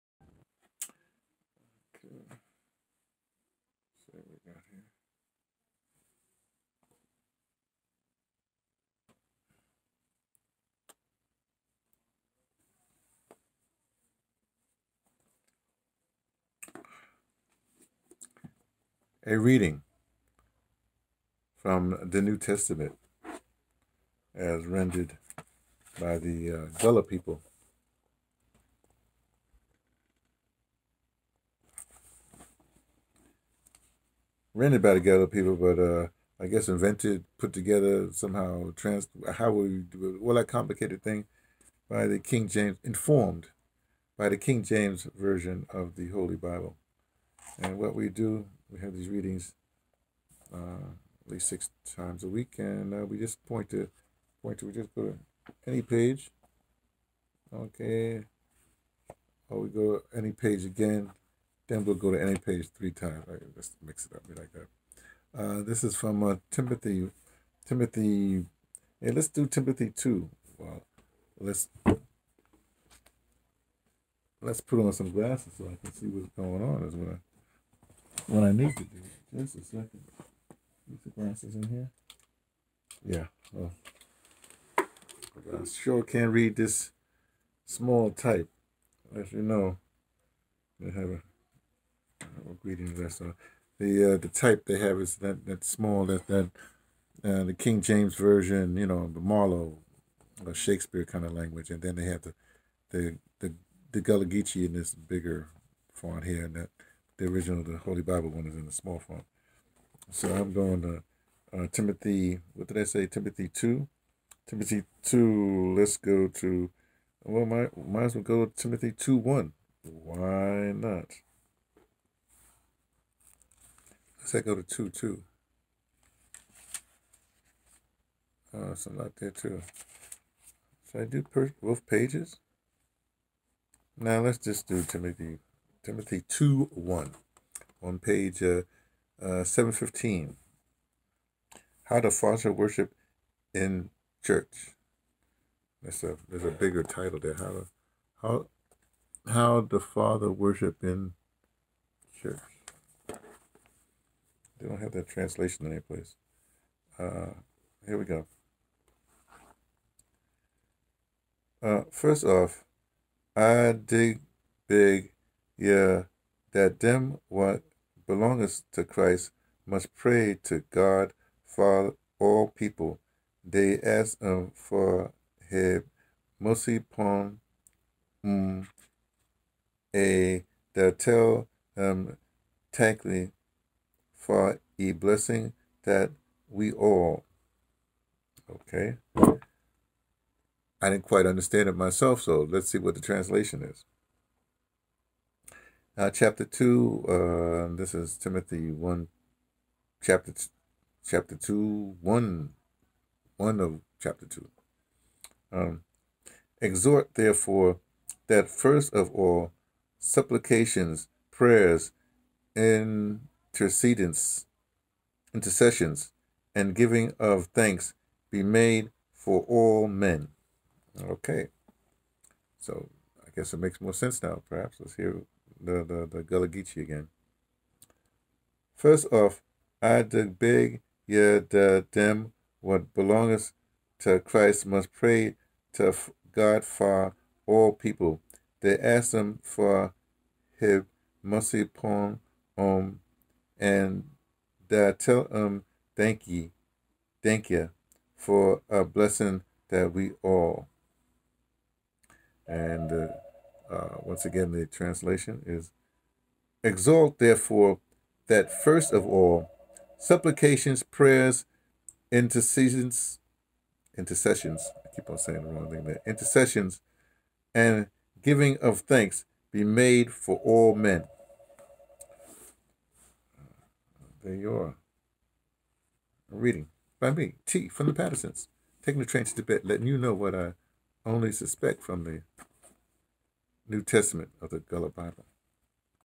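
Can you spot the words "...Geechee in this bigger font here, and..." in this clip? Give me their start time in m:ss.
1:44.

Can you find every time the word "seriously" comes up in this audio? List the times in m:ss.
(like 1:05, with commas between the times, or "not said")
not said.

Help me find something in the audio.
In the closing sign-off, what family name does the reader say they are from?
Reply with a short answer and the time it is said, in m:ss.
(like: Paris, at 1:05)
Pattersons, at 4:37.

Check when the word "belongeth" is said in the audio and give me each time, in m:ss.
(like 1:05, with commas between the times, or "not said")
2:48, 3:52.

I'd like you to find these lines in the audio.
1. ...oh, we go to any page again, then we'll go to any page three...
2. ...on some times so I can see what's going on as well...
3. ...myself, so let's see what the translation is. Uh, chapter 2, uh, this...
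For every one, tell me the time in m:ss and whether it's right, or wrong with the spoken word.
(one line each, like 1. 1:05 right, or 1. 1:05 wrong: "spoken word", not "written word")
1. 0:59 right
2. 1:14 wrong: "glasses", not "times"
3. 3:11 right.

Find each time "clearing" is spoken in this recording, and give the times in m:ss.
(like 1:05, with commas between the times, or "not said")
not said.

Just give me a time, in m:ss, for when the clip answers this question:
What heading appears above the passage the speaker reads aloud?
2:21.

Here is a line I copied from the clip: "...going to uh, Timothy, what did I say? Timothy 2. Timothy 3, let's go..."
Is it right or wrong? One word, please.
wrong.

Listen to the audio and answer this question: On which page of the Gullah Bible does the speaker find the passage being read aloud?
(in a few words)
715.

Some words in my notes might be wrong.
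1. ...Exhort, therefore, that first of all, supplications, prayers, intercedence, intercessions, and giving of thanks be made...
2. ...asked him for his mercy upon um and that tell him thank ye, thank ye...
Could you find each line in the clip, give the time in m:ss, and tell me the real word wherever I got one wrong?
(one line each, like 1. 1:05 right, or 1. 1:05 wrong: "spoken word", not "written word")
1. 3:26 right
2. 3:58 right.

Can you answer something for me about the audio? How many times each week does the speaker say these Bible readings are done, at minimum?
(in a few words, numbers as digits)
6.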